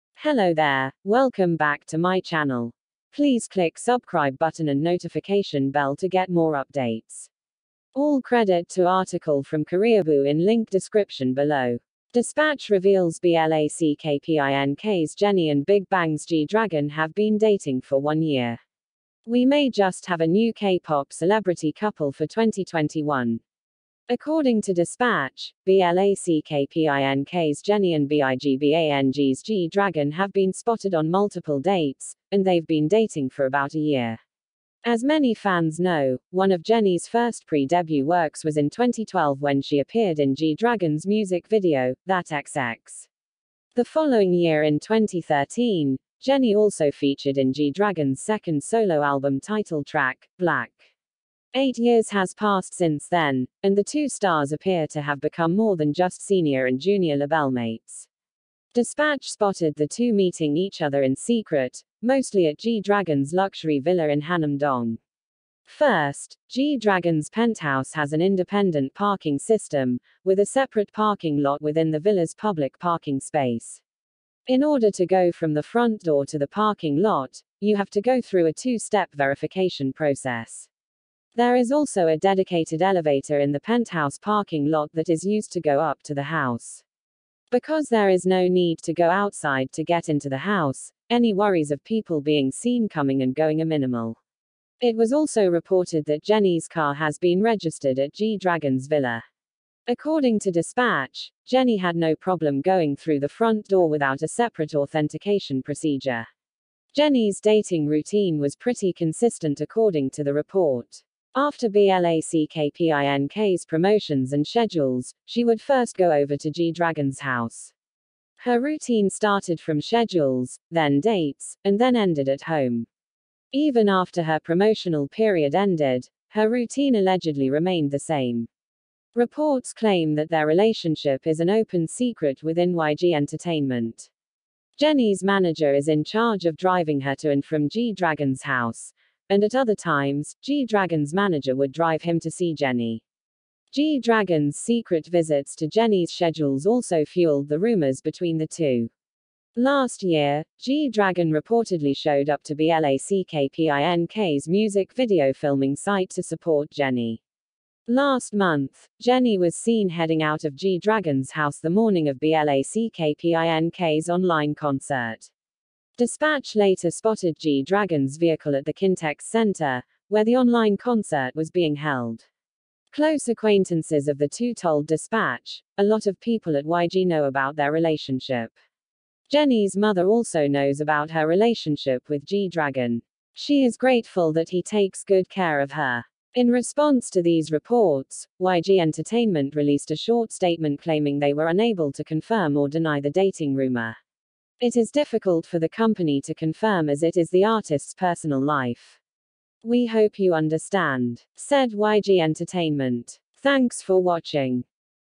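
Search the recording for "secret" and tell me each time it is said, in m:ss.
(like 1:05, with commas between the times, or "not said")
1:01, 2:11, 2:24.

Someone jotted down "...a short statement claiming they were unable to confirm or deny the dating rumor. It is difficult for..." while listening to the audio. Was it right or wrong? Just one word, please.
right.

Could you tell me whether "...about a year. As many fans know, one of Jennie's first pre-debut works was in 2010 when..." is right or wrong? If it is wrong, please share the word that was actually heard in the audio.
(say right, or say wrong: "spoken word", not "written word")
wrong: "2012", not "2010".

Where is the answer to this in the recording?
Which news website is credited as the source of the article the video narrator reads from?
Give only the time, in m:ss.
0:09.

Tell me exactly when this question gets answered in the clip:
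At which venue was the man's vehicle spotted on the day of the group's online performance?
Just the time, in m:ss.
2:48.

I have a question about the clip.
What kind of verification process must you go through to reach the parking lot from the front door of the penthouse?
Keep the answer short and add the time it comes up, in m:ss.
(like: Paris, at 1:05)
Two step, at 1:18.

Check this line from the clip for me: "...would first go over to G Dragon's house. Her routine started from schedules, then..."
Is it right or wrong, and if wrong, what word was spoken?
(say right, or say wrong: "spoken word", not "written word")
right.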